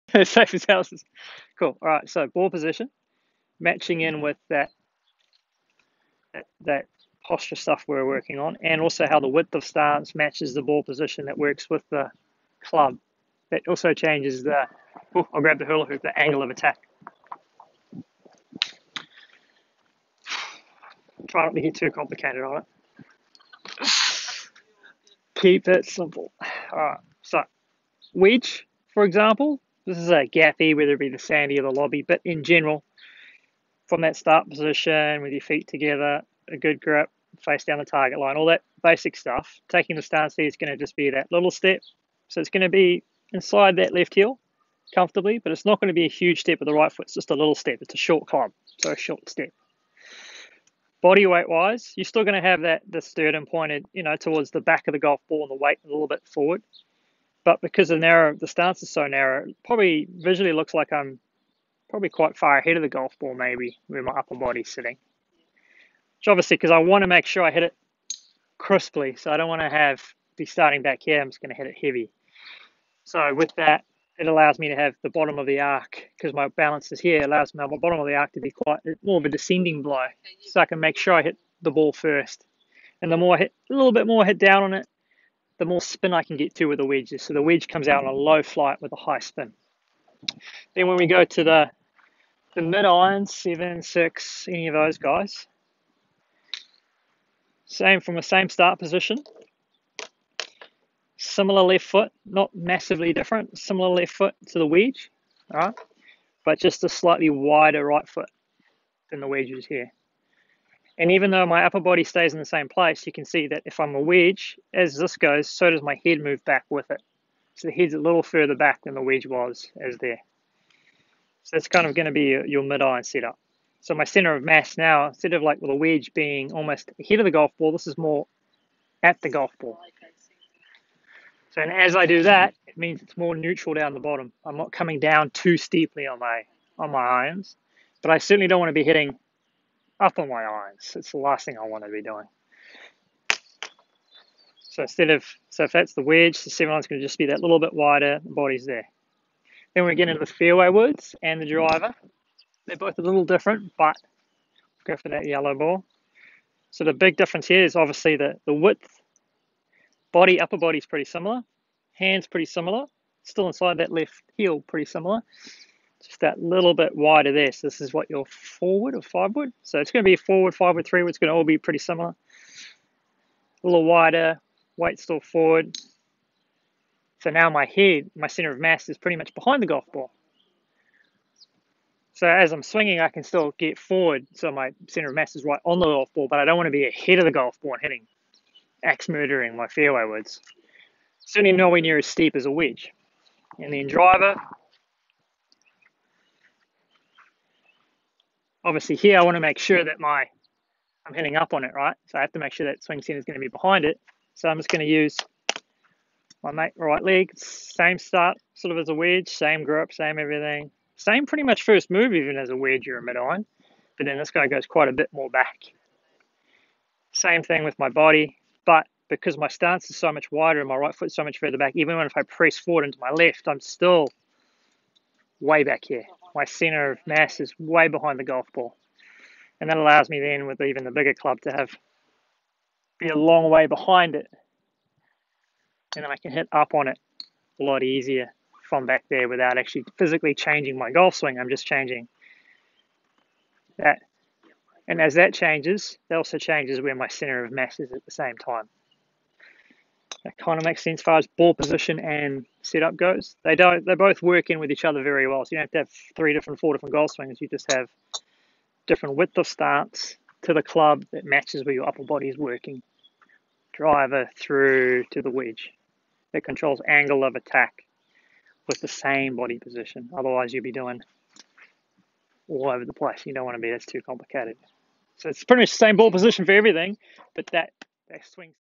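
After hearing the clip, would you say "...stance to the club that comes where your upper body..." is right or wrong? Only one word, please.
wrong.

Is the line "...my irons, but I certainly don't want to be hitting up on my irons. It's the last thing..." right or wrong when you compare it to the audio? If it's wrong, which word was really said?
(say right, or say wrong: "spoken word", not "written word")
right.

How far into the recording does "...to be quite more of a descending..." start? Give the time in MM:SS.
01:18.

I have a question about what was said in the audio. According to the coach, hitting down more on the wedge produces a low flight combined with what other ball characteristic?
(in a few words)
high spin.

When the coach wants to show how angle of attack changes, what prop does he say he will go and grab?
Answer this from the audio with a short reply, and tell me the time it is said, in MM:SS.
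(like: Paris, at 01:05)
hula hoop, at 00:15.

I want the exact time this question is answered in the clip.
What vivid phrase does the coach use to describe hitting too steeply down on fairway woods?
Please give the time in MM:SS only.
03:08.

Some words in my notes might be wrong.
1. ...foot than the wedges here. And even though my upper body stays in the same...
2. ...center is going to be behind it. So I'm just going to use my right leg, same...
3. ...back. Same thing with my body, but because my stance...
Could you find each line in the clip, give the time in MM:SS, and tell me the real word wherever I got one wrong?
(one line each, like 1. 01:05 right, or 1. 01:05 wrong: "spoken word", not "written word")
1. 01:48 right
2. 03:23 right
3. 03:35 right.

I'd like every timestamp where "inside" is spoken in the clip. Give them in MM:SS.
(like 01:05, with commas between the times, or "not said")
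00:43, 02:43.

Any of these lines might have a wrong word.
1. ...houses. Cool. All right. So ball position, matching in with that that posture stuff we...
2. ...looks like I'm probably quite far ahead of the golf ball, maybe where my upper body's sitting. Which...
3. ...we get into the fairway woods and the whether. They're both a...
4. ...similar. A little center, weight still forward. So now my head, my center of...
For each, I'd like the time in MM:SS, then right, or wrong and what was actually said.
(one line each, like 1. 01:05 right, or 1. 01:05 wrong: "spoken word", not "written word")
1. 00:00 right
2. 01:00 right
3. 02:29 wrong: "driver", not "whether"
4. 02:51 wrong: "wider", not "center".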